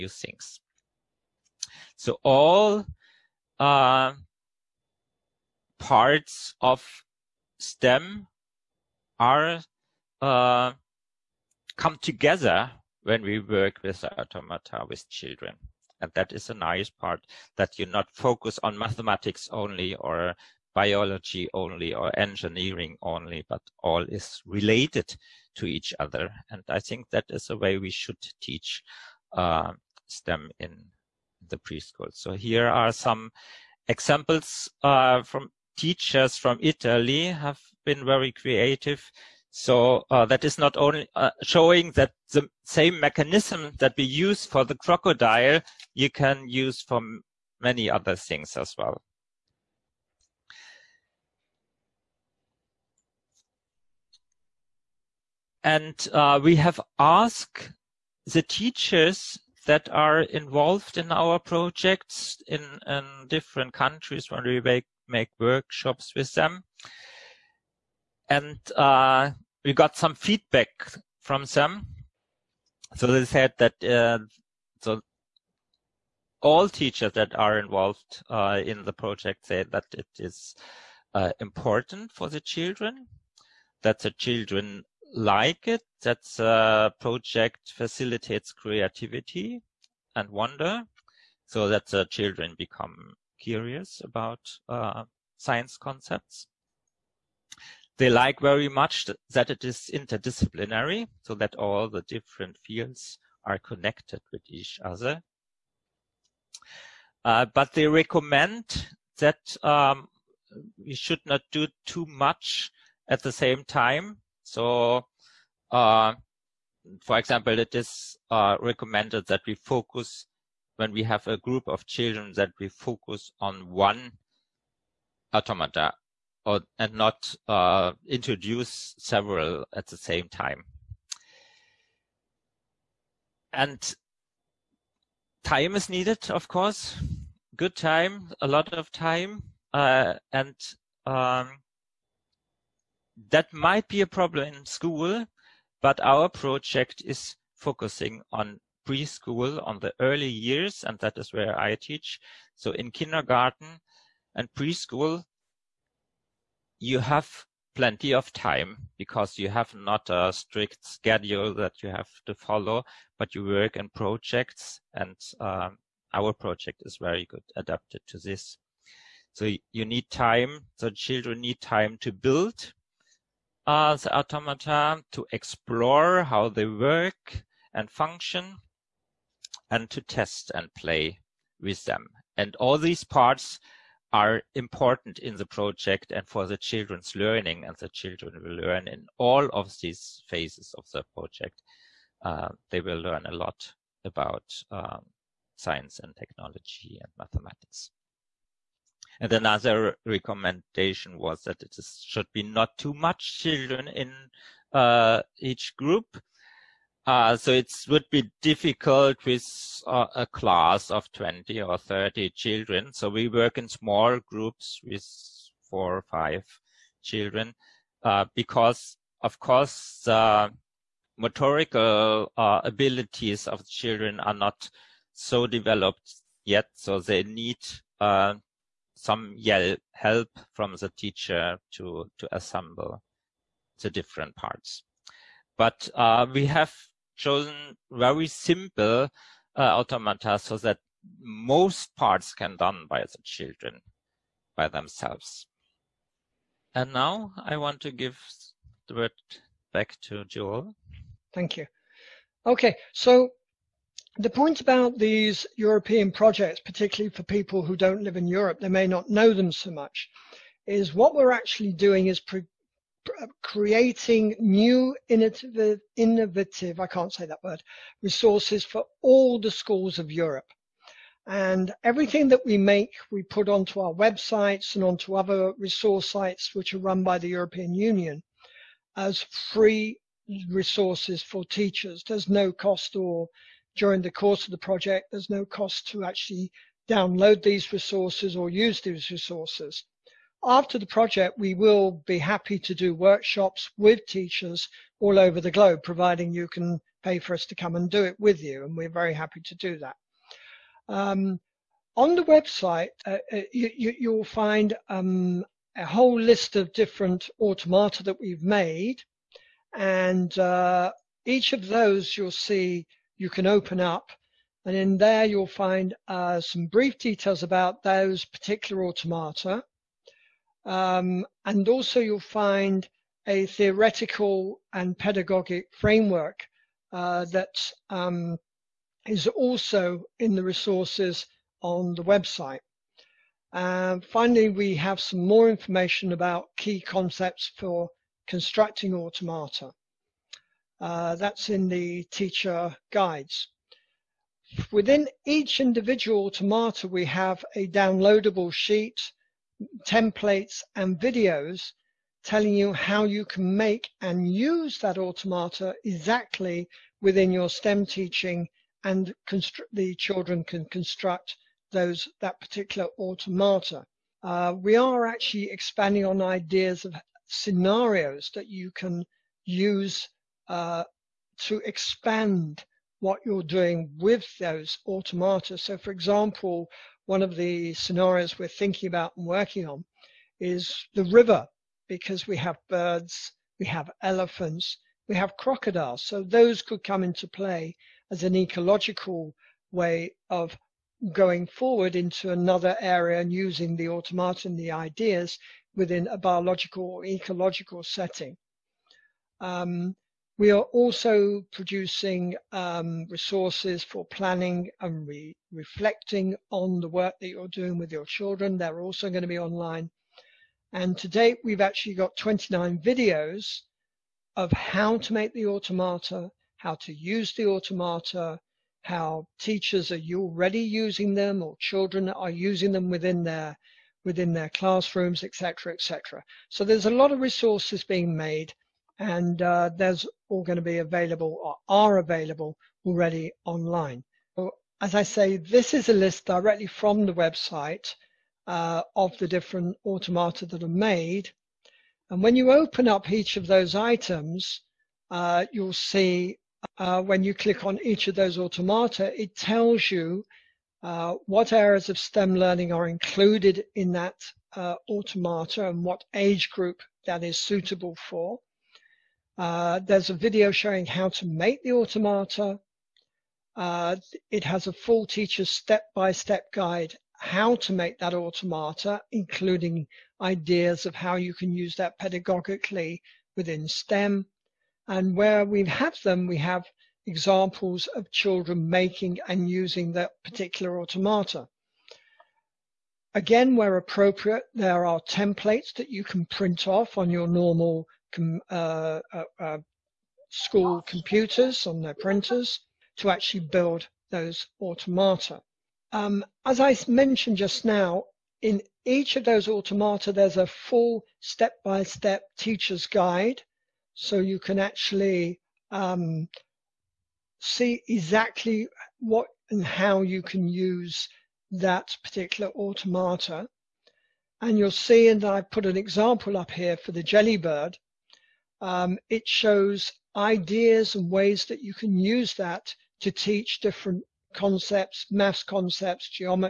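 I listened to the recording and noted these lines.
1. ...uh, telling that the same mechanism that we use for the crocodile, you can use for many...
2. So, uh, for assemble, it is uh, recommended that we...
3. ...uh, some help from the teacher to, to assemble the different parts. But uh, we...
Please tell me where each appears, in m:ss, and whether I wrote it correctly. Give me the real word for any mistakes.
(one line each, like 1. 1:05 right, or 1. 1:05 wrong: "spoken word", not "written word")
1. 0:41 wrong: "showing", not "telling"
2. 1:54 wrong: "example", not "assemble"
3. 3:47 right.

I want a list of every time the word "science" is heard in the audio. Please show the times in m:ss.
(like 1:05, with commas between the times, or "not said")
1:35, 3:15.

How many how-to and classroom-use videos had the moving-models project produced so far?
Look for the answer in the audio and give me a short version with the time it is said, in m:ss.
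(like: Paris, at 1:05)
29, at 6:52.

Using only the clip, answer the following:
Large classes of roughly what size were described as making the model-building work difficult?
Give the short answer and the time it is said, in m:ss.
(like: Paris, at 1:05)
20 or 30 children, at 3:31.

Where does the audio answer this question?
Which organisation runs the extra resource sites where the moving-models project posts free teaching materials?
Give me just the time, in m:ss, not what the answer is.
4:37.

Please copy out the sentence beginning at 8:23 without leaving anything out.
So you can actually um, see exactly what and how you can use that particular automata.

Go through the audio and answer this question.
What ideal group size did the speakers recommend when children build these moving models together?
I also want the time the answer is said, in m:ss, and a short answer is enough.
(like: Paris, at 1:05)
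4 or 5 children, at 3:35.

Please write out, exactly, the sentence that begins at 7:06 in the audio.
So there's a lot of resources being made, and uh, there's all going to be available or are available already online.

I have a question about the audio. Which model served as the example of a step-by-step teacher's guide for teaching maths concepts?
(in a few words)
Jellybird.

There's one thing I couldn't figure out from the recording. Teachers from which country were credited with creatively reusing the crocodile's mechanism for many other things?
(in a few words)
Italy.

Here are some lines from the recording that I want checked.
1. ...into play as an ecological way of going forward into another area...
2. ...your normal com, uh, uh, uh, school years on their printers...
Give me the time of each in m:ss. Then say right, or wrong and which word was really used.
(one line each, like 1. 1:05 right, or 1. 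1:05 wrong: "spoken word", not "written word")
1. 6:27 right
2. 8:07 wrong: "computers", not "years".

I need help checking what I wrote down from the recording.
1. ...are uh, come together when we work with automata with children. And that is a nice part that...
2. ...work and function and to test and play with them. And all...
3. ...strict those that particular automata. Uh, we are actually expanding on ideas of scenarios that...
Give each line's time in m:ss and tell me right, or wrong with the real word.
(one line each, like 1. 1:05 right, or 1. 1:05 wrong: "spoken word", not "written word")
1. 0:09 right
2. 2:56 right
3. 6:00 wrong: "construct", not "strict".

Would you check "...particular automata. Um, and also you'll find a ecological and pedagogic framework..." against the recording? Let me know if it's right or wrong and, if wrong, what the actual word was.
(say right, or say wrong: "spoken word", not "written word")
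wrong: "theoretical", not "ecological".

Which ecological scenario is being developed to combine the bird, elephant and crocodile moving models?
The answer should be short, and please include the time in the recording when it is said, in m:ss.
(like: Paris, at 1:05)
The river, at 6:20.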